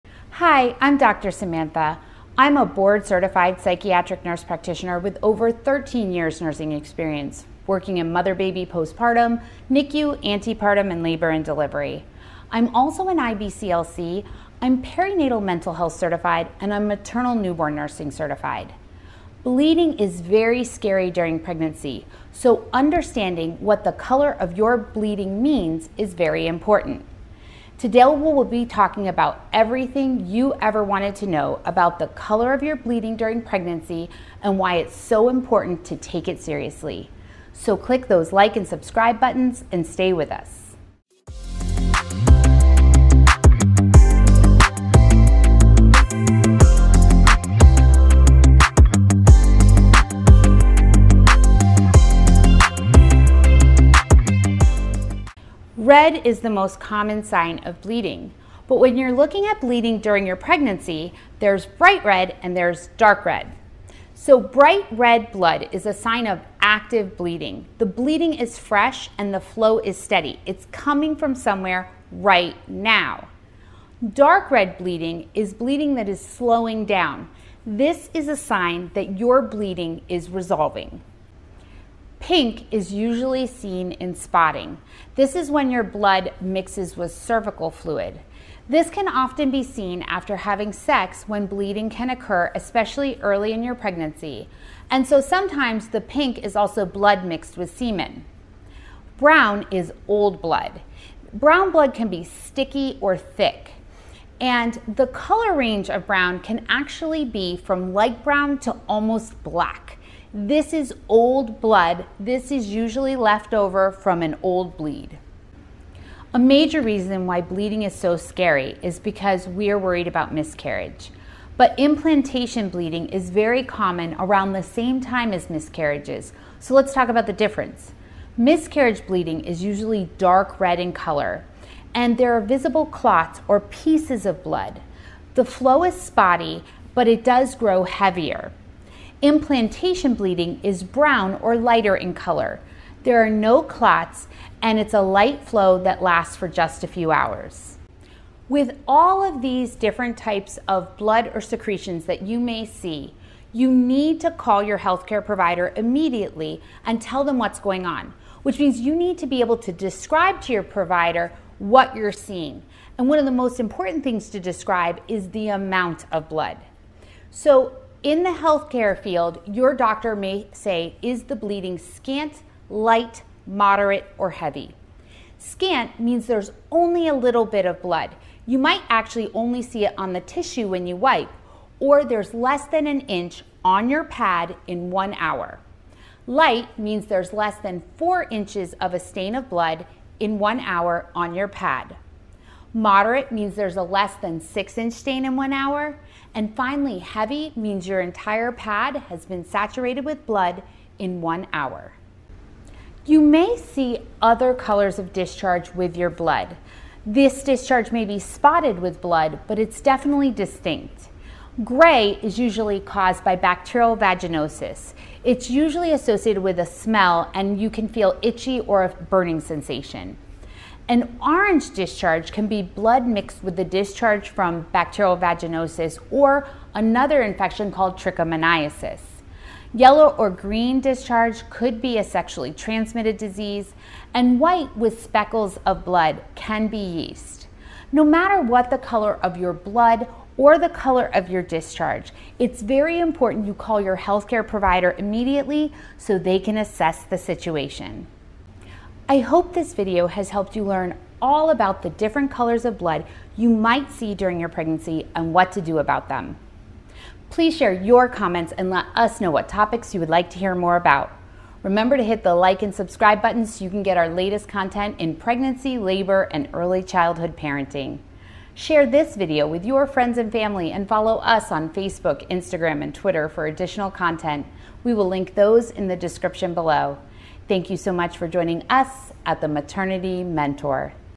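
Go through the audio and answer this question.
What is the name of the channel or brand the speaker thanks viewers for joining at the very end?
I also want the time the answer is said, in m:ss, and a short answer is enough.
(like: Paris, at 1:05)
The Maternity Mentor, at 4:39.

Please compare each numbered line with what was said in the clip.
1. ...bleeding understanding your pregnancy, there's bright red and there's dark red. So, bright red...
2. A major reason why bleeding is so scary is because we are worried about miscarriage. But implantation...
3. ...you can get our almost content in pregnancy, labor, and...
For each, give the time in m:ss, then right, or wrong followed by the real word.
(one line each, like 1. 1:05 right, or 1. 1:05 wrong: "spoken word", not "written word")
1. 0:59 wrong: "during", not "understanding"
2. 1:56 right
3. 4:23 wrong: "latest", not "almost".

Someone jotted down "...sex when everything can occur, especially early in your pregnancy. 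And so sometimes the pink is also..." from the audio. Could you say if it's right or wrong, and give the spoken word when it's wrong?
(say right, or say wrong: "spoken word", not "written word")
wrong: "bleeding", not "everything".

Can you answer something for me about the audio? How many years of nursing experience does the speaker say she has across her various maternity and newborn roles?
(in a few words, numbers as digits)
13.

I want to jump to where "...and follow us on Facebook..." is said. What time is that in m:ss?
4:30.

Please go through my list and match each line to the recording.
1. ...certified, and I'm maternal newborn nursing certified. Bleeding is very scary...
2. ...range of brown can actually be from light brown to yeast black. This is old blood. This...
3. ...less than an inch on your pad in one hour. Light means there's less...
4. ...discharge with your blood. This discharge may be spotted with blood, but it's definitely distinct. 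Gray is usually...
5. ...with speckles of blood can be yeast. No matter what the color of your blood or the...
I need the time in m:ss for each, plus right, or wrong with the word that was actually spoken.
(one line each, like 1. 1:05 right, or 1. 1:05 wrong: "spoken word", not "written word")
1. 0:15 right
2. 1:45 wrong: "almost", not "yeast"
3. 3:02 right
4. 3:25 right
5. 3:54 right.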